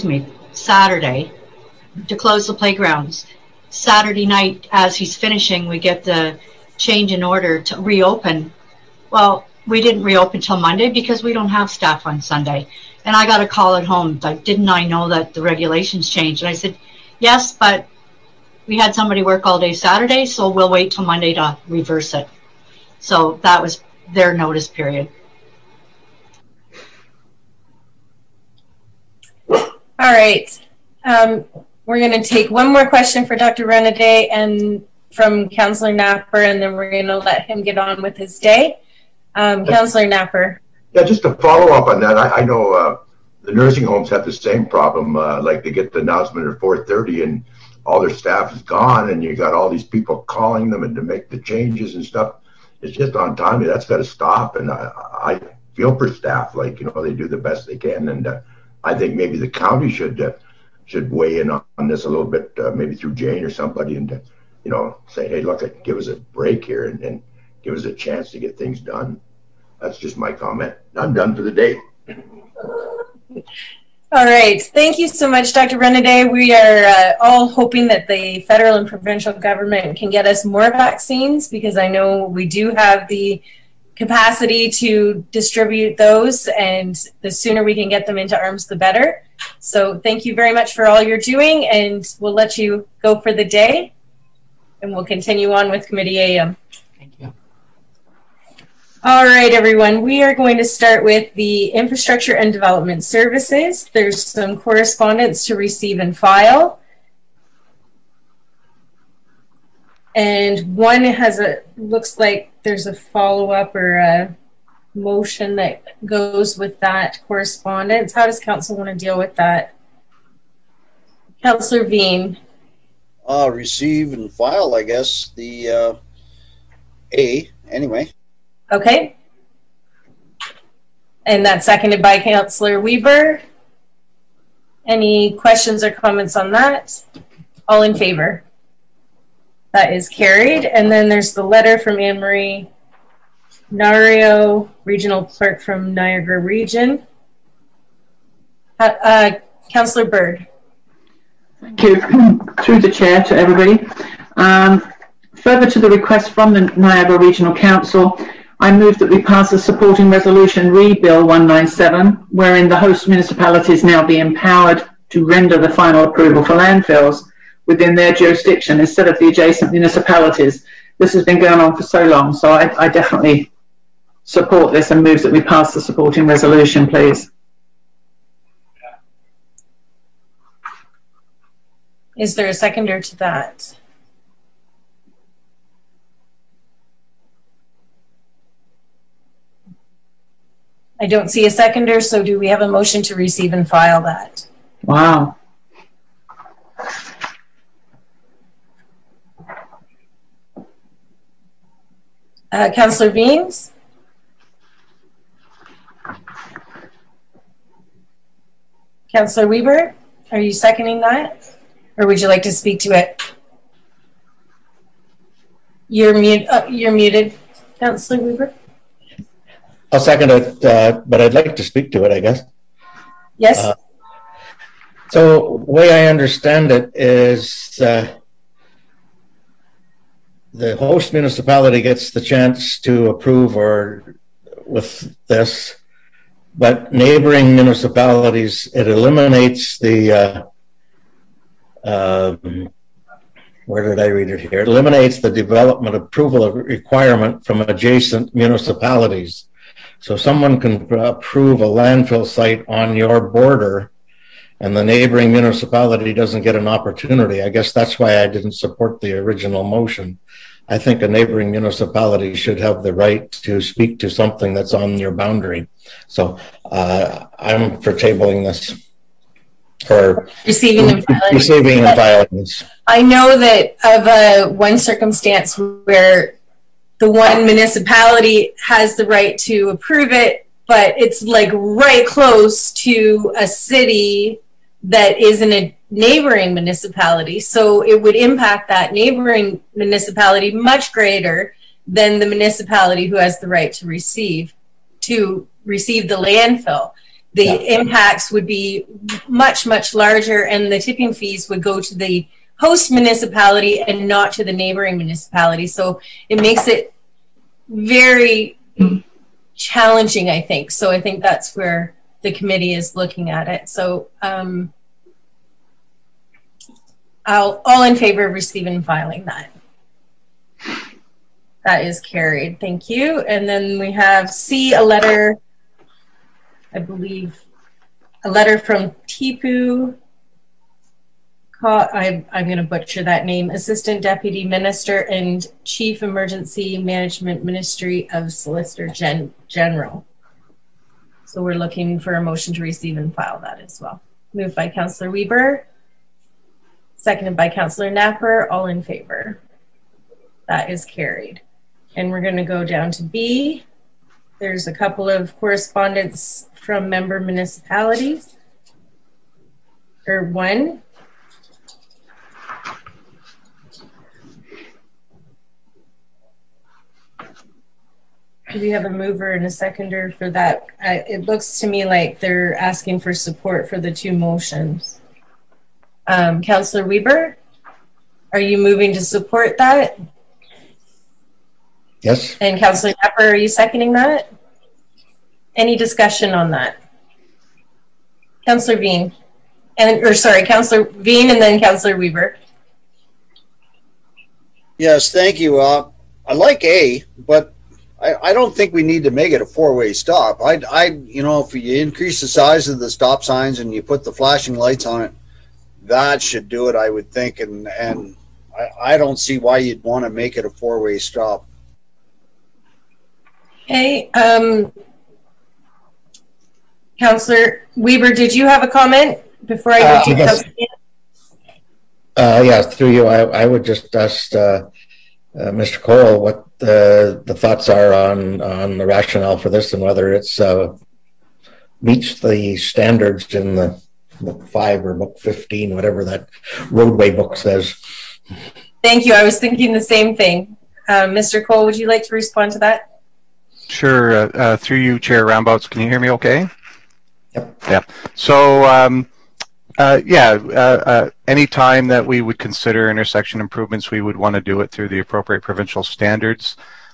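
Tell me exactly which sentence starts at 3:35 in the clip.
You're, mute, uh, you're muted, Councillor Weber.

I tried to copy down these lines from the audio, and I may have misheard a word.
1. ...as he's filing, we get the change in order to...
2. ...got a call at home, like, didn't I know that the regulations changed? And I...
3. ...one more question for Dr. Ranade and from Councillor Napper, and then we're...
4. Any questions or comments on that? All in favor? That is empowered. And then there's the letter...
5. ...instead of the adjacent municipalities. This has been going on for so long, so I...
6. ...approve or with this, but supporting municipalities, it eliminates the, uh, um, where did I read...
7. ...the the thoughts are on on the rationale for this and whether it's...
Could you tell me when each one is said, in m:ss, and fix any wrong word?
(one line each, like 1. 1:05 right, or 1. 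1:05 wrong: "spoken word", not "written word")
1. 0:04 wrong: "finishing", not "filing"
2. 0:13 right
3. 0:32 right
4. 2:14 wrong: "carried", not "empowered"
5. 2:48 right
6. 3:53 wrong: "neighboring", not "supporting"
7. 7:06 right.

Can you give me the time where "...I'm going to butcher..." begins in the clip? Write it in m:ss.
5:32.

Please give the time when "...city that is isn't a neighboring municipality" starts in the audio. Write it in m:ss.
4:43.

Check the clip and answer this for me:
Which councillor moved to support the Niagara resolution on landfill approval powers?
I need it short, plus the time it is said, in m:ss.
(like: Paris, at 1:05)
Councillor Bird, at 2:29.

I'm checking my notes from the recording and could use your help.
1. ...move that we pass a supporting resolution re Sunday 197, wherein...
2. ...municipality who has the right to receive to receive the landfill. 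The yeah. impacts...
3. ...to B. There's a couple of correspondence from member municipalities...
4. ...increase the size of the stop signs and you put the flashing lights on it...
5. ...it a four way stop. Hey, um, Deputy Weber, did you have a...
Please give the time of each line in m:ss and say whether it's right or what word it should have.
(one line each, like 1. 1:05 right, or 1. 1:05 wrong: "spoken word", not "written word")
1. 2:38 wrong: "Bill", not "Sunday"
2. 4:52 right
3. 5:52 right
4. 6:41 right
5. 6:50 wrong: "Councillor", not "Deputy".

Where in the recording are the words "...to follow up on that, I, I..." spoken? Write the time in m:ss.
0:41.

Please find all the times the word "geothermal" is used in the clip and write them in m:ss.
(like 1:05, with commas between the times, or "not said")
not said.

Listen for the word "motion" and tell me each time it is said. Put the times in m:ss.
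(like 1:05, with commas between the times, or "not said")
1:54, 3:12, 4:19, 5:42, 6:14.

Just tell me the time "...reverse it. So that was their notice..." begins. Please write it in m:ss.
0:21.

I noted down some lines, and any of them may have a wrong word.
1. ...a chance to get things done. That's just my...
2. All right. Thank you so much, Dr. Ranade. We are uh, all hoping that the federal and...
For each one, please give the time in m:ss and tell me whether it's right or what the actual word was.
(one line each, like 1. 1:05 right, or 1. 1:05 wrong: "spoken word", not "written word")
1. 1:07 right
2. 1:14 right.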